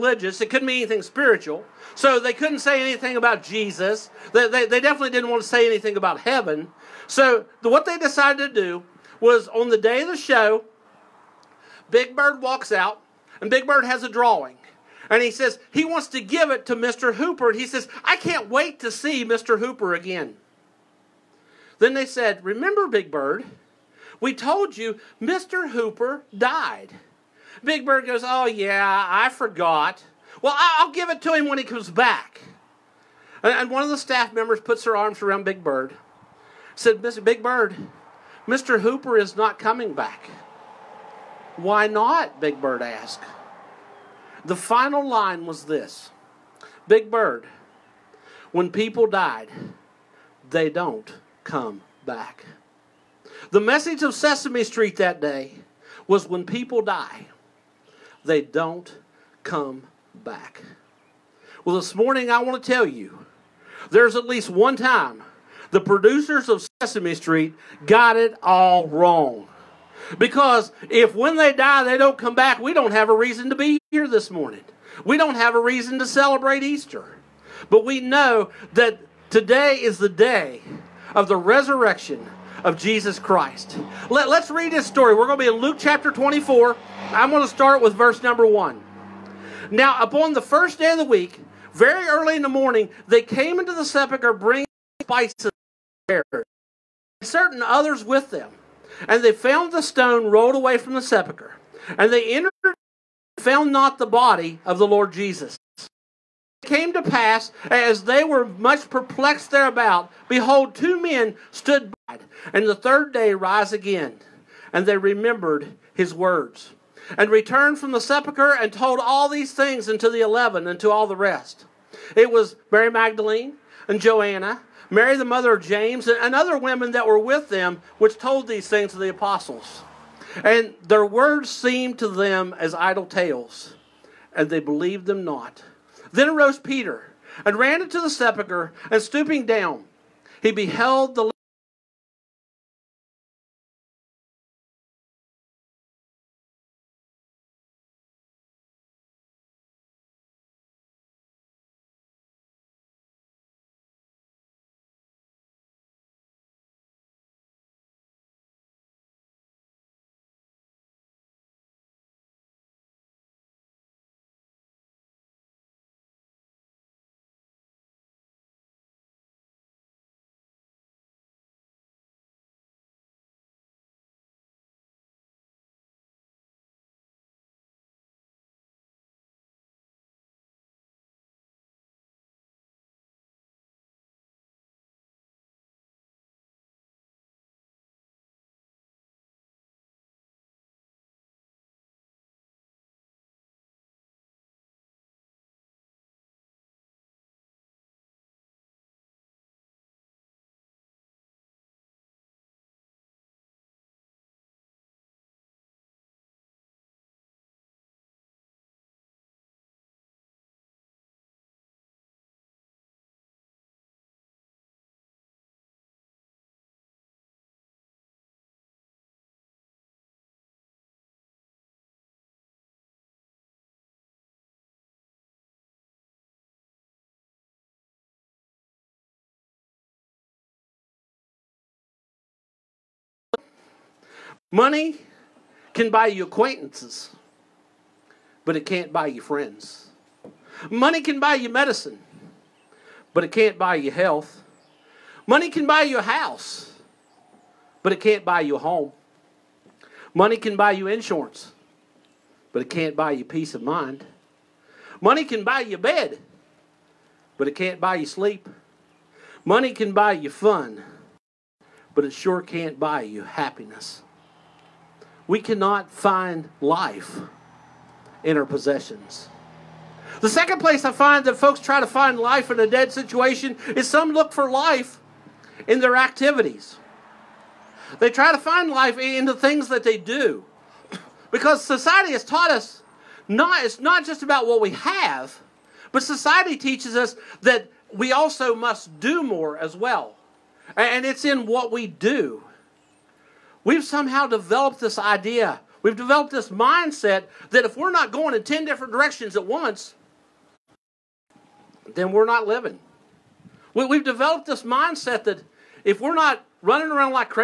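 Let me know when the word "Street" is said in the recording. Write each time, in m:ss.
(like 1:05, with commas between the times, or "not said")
0:54, 1:07.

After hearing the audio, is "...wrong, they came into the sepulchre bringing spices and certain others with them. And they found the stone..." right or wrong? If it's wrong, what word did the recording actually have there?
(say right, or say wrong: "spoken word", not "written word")
wrong: "morning", not "wrong".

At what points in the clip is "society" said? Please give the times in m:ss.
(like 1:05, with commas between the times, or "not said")
4:41, 4:46.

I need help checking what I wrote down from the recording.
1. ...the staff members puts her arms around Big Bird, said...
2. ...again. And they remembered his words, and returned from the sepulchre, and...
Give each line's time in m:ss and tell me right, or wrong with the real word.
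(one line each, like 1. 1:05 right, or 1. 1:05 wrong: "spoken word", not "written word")
1. 0:33 right
2. 1:53 right.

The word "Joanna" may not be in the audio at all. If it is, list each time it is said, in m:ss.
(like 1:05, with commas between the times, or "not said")
2:04.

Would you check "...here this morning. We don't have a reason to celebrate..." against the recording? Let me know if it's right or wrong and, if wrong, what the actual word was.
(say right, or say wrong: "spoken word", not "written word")
right.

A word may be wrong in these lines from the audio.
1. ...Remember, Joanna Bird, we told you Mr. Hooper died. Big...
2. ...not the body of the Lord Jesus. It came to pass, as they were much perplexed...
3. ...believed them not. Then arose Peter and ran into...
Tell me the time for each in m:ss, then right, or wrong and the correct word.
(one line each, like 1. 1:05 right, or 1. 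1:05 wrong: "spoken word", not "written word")
1. 0:22 wrong: "Big", not "Joanna"
2. 1:43 right
3. 2:14 right.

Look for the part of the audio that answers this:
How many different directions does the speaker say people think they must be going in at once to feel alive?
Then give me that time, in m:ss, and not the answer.
4:58.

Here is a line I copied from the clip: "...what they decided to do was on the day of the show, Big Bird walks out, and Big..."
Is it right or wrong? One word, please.
right.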